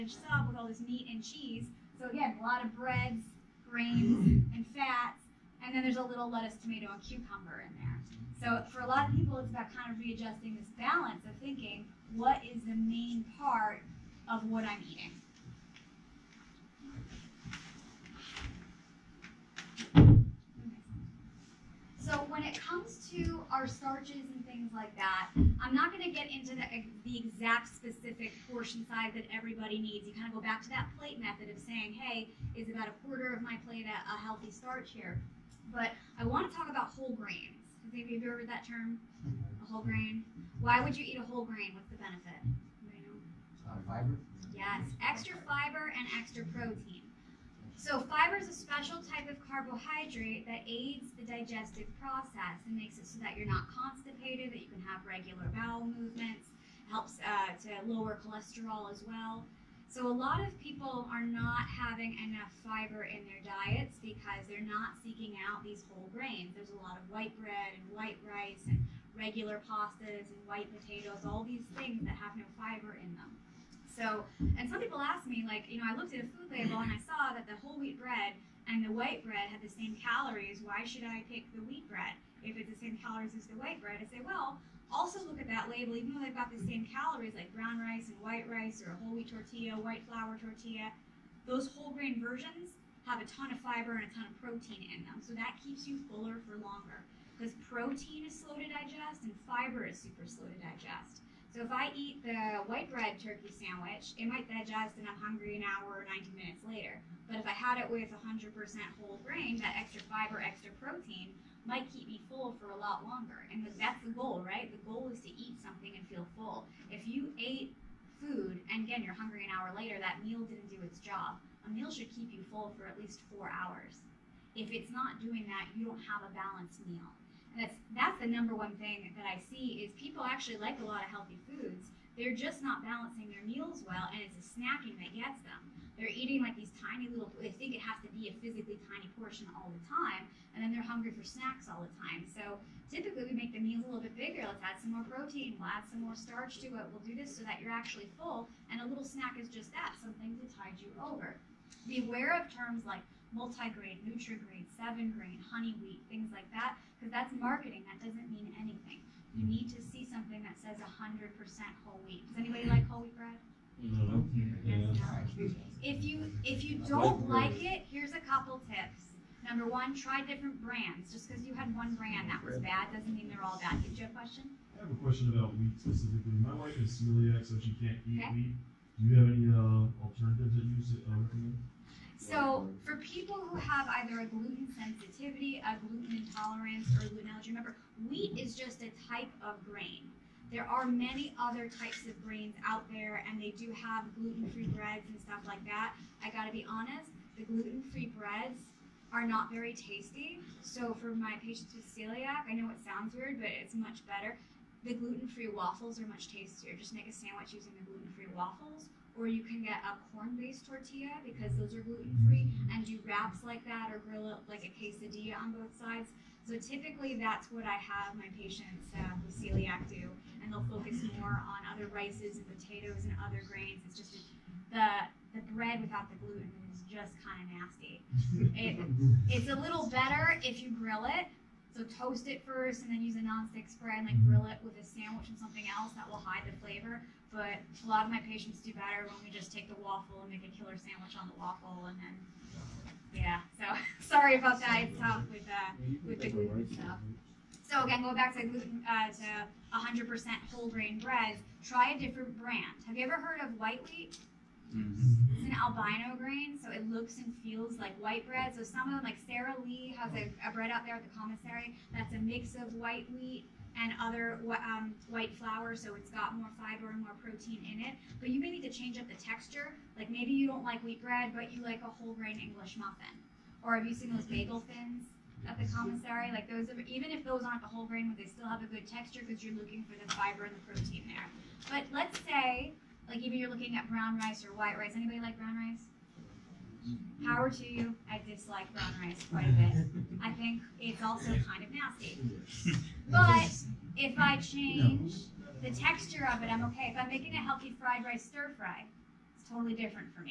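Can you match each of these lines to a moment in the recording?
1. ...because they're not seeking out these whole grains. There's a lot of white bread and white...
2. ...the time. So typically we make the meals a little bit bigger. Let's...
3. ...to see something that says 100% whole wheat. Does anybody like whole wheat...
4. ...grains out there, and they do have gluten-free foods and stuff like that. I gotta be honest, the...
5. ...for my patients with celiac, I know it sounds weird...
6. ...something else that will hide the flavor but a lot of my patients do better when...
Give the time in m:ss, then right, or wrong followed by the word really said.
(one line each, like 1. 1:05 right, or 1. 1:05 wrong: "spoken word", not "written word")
1. 1:03 right
2. 2:21 right
3. 2:39 right
4. 3:12 wrong: "breads", not "foods"
5. 3:20 right
6. 3:55 right.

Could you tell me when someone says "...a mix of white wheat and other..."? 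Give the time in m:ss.
4:22.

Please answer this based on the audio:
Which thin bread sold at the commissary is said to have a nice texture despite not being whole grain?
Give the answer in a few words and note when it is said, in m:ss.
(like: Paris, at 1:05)
bagel thins, at 4:34.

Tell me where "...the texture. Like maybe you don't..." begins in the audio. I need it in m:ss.
4:29.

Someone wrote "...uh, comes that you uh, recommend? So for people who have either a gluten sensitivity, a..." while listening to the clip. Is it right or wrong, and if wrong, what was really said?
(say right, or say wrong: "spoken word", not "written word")
wrong: "alternatives", not "comes".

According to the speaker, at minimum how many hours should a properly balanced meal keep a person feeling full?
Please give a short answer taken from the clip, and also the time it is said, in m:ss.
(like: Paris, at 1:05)
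4 hours, at 2:03.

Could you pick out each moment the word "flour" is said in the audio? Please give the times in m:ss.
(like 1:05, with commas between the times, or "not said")
1:30, 4:25.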